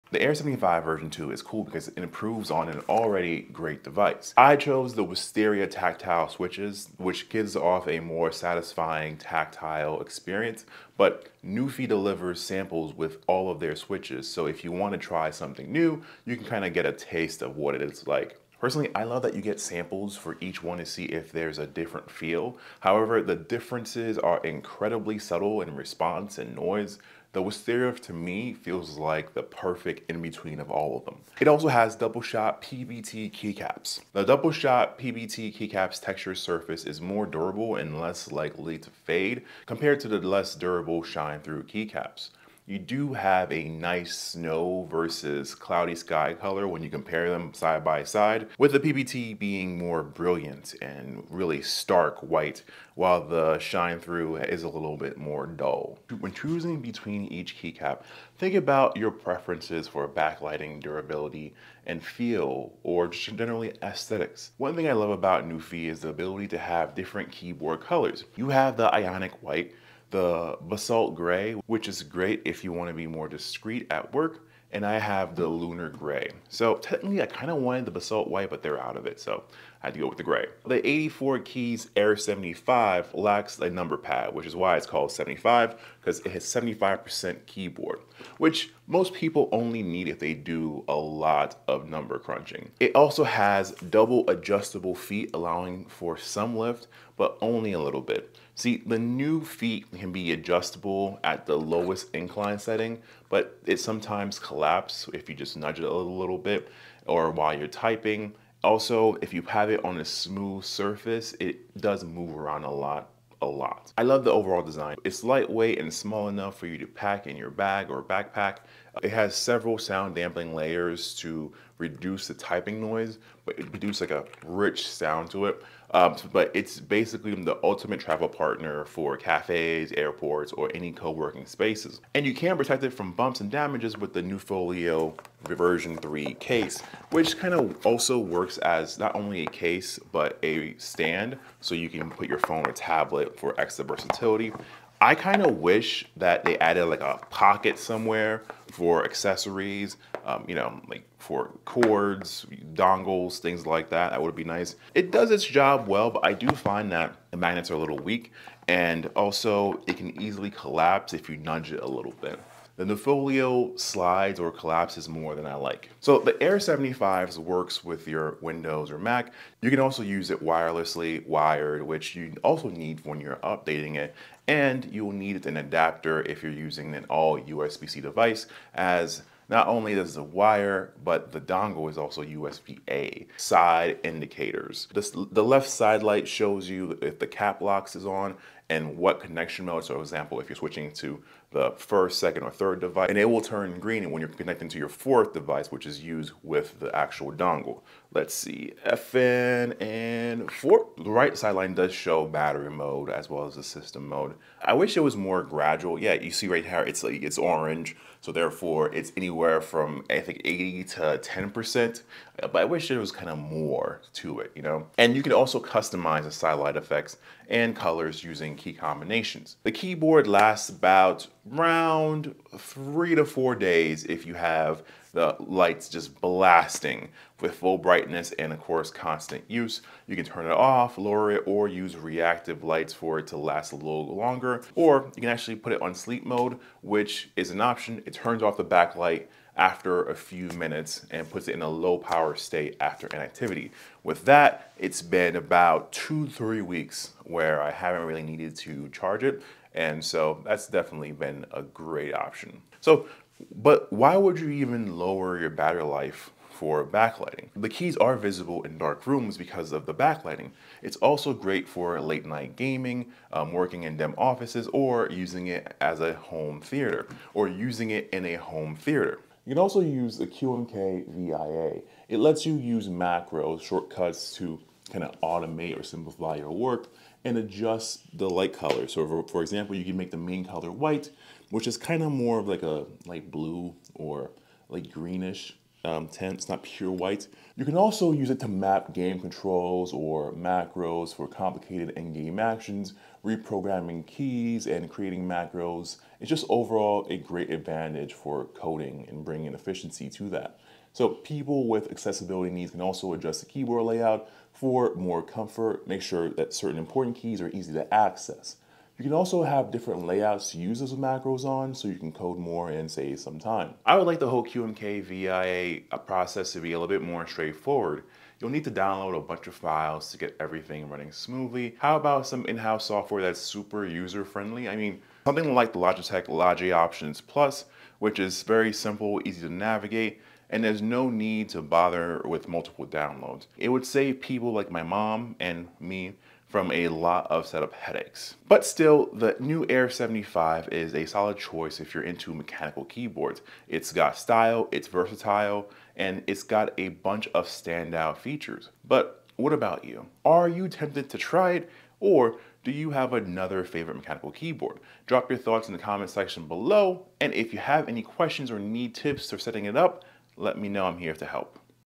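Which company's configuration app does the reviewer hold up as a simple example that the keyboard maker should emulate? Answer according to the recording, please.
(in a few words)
Logitech.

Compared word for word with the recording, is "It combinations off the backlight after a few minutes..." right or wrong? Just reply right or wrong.
wrong.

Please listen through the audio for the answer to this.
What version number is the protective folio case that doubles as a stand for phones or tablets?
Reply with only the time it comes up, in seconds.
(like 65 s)
135 s.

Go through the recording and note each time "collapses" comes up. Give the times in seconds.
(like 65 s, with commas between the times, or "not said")
104 s, 160 s, 164 s.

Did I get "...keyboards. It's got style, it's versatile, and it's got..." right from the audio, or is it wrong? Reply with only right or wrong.
right.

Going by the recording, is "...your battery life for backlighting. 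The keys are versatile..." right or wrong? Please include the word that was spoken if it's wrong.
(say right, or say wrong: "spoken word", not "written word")
wrong: "visible", not "versatile".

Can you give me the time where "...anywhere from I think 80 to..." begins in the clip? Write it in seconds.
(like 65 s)
209 s.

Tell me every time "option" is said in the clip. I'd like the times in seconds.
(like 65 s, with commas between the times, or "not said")
237 s, 252 s, 326 s.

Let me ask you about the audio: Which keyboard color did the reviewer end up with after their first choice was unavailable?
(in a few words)
Lunar gray.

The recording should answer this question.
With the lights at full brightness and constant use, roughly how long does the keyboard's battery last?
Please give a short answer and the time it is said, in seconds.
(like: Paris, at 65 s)
3 to 4 days, at 222 s.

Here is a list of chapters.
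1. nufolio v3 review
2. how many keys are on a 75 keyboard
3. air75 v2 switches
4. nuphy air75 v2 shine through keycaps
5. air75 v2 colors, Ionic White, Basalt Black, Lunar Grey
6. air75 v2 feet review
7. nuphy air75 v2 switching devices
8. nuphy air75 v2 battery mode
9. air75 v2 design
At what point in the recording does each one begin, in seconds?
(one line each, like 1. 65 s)
1. 133 s
2. 81 s
3. 10 s
4. 31 s
5. 65 s
6. 92 s
7. 168 s
8. 201 s
9. 111 s.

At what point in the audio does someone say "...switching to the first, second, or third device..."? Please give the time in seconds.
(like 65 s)
190 s.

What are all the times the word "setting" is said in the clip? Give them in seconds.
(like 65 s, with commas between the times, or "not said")
102 s, 359 s.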